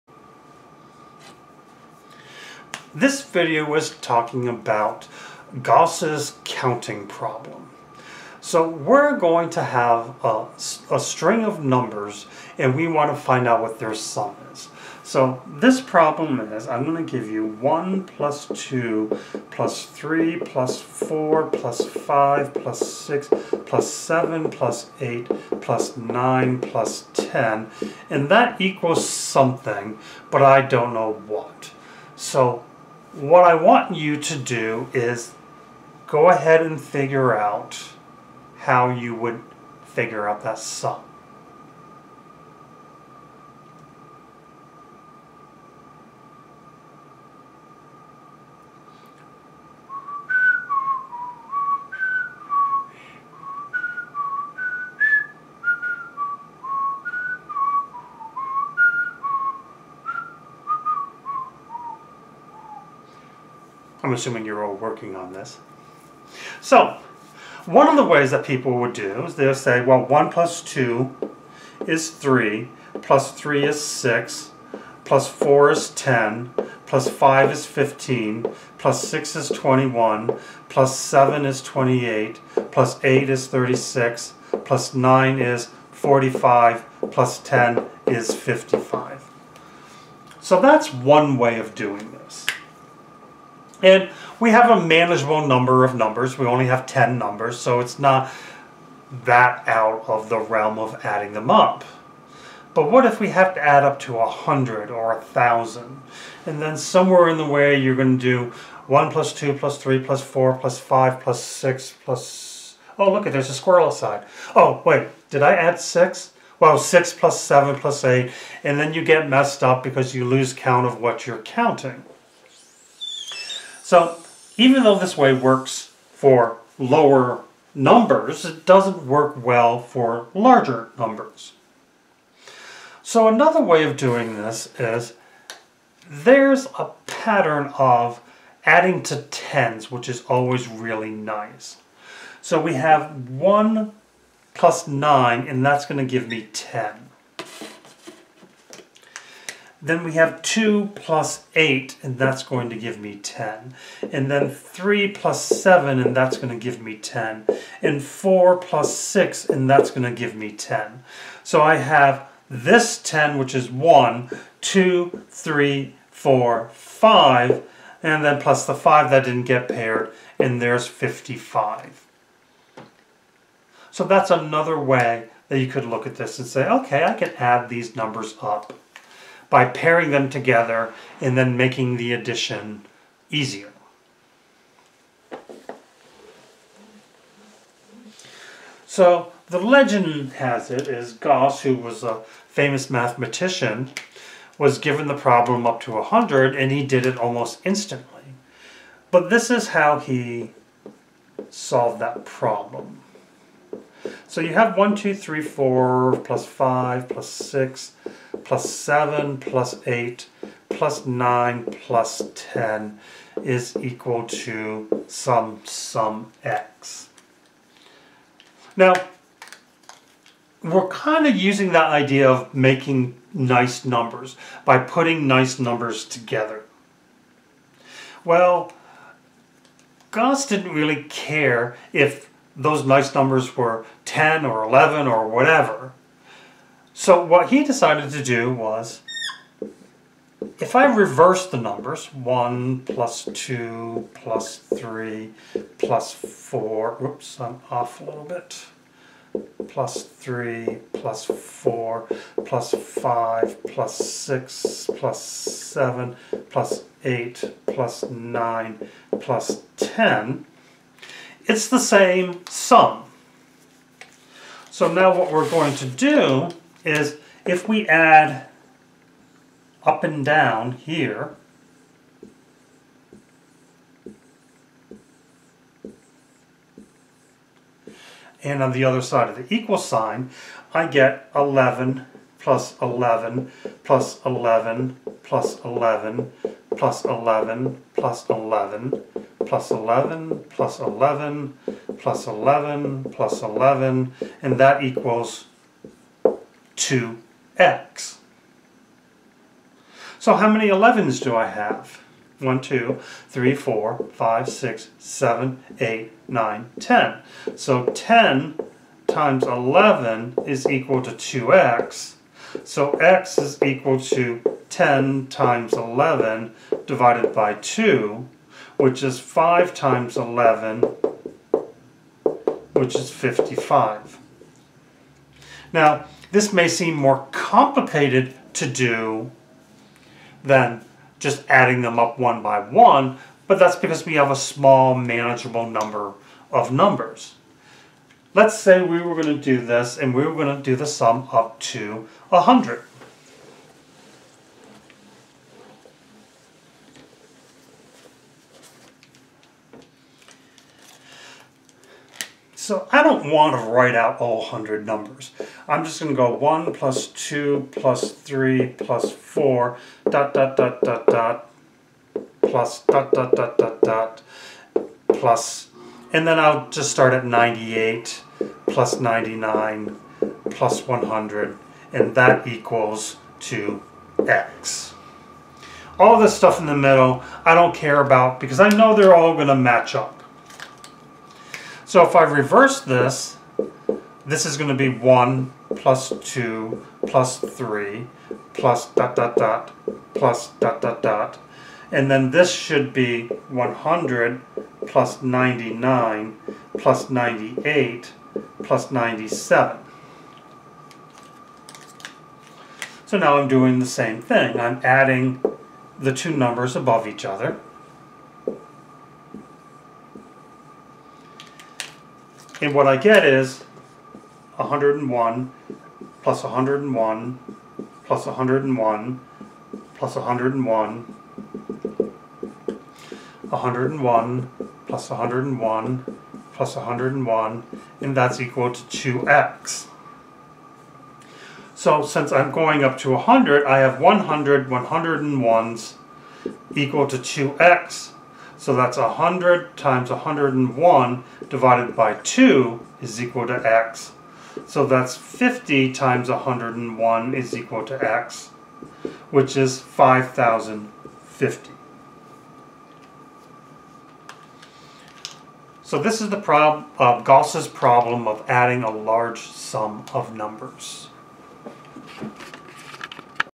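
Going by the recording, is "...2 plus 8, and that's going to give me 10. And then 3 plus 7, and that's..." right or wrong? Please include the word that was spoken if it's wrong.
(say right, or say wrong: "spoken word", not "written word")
right.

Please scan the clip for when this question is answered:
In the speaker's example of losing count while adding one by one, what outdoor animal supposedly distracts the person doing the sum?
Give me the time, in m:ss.
1:53.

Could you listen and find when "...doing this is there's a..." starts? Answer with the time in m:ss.
2:13.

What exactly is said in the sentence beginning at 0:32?
So what I want you to do is go ahead and figure out how you would figure out that sum.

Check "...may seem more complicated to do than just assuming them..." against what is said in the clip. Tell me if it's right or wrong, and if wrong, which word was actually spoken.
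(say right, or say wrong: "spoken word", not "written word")
wrong: "adding", not "assuming".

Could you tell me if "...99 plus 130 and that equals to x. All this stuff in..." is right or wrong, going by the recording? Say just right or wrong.
wrong.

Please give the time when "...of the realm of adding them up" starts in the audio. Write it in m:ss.
1:40.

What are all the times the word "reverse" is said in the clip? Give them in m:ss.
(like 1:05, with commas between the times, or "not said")
4:00, 6:22.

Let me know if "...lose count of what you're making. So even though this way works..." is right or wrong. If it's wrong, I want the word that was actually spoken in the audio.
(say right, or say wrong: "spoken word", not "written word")
wrong: "counting", not "making".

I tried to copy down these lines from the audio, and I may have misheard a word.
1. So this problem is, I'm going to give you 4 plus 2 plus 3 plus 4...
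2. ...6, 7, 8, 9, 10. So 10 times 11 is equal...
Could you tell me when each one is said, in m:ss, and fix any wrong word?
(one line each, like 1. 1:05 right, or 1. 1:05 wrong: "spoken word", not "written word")
1. 0:15 wrong: "1", not "4"
2. 5:04 right.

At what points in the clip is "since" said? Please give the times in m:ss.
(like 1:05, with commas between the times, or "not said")
7:12.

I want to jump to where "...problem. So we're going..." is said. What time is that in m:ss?
0:07.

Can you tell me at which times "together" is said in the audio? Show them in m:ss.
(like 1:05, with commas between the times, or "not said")
3:00, 3:46.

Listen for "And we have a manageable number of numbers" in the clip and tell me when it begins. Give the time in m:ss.
1:33.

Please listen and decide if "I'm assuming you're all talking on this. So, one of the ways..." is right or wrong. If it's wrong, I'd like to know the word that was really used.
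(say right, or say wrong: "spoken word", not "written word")
wrong: "working", not "talking".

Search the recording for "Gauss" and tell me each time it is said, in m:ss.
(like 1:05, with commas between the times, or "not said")
0:05, 3:11, 3:50, 7:37.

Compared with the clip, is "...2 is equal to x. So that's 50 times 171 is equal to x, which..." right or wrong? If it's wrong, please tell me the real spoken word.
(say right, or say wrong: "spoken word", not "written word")
wrong: "101", not "171".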